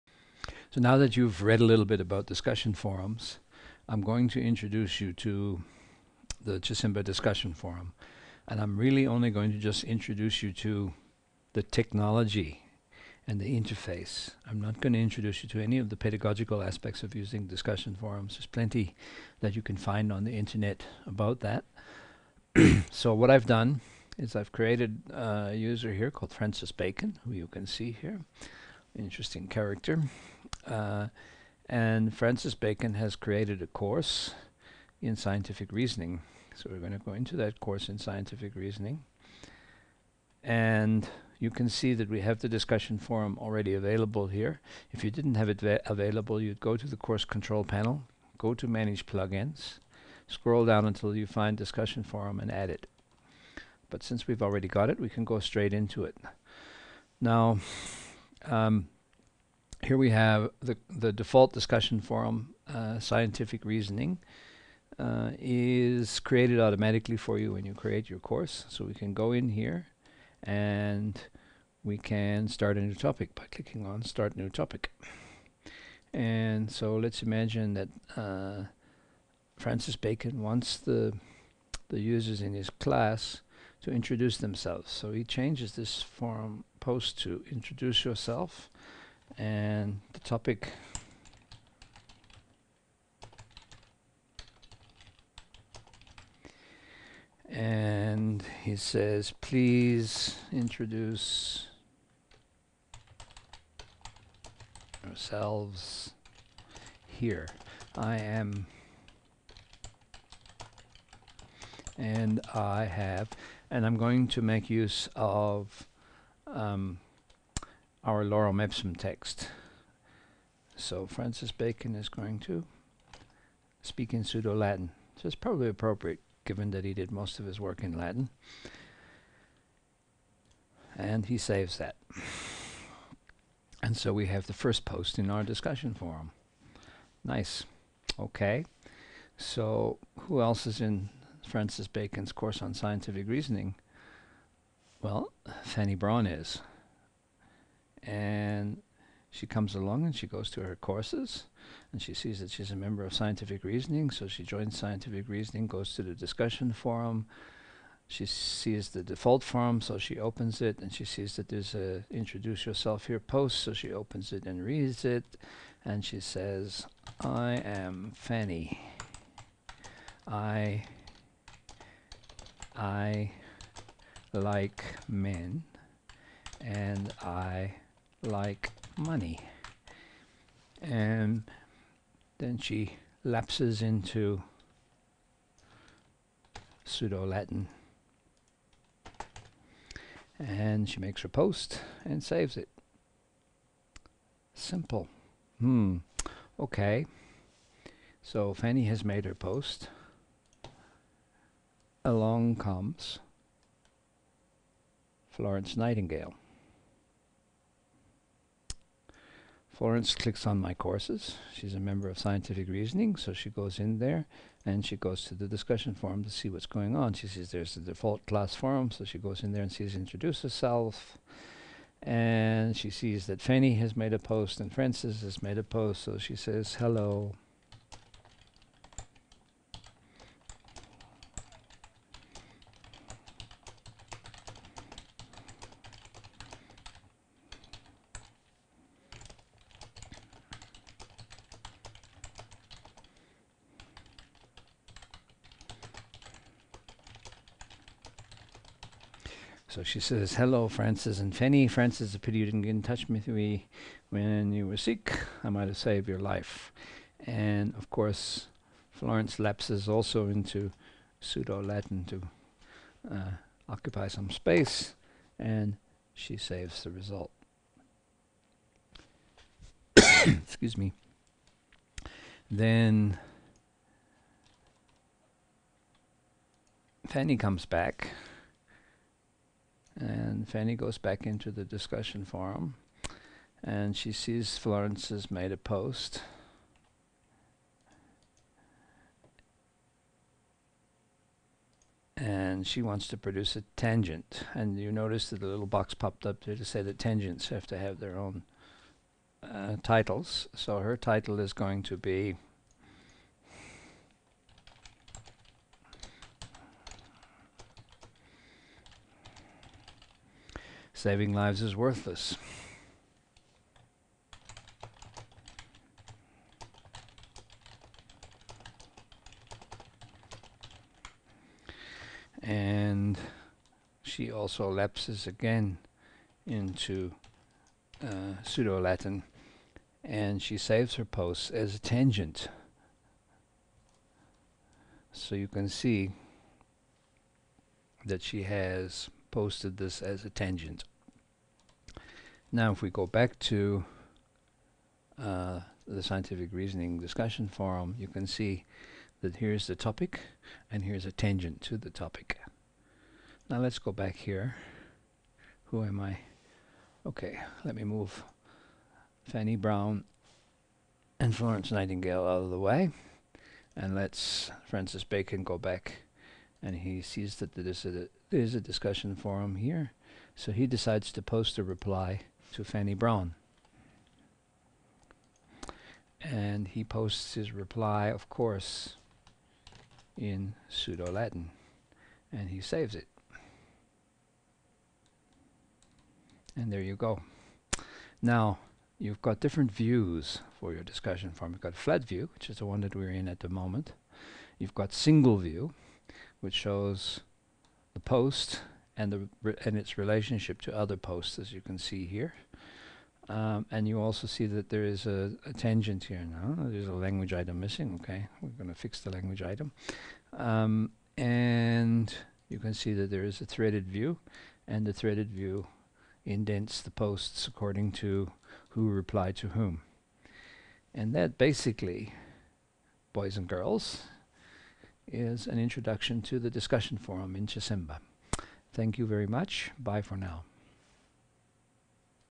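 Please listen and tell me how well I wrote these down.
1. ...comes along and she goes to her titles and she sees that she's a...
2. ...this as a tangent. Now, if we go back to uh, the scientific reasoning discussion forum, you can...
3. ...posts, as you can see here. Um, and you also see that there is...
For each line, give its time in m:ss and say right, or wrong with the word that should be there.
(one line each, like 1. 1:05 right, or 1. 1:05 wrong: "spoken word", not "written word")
1. 2:29 wrong: "courses", not "titles"
2. 5:39 right
3. 6:40 right.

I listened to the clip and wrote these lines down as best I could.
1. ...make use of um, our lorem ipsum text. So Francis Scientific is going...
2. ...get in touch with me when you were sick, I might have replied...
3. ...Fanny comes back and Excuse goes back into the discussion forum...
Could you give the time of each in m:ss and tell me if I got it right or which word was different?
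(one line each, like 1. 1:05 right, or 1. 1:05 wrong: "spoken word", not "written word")
1. 1:54 wrong: "Bacon", not "Scientific"
2. 4:12 wrong: "saved", not "replied"
3. 4:37 wrong: "Fanny", not "Excuse".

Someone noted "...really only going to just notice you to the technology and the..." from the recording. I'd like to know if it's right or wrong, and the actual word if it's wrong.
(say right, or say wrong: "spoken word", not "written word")
wrong: "introduce", not "notice".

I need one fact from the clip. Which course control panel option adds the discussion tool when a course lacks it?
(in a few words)
Manage plugins.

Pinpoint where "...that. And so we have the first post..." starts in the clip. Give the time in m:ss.
2:11.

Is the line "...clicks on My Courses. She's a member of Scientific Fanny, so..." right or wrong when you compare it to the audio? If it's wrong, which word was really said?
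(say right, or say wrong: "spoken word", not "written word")
wrong: "Reasoning", not "Fanny".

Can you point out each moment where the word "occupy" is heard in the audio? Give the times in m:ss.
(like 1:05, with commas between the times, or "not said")
4:23.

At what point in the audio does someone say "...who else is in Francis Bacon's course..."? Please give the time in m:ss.
2:20.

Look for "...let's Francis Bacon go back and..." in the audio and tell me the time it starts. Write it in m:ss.
6:03.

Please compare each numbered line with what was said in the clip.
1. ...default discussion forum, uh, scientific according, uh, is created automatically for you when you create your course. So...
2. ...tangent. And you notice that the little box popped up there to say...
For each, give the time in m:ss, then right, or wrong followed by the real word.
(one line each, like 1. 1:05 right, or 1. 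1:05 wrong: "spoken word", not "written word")
1. 1:01 wrong: "reasoning", not "according"
2. 4:53 right.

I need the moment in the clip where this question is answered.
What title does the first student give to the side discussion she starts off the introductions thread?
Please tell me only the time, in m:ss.
5:11.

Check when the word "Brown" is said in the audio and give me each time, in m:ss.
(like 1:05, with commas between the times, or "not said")
5:59, 6:12.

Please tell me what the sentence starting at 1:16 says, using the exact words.
And so let's imagine that uh, Francis Bacon wants the, the users in his class to introduce themselves.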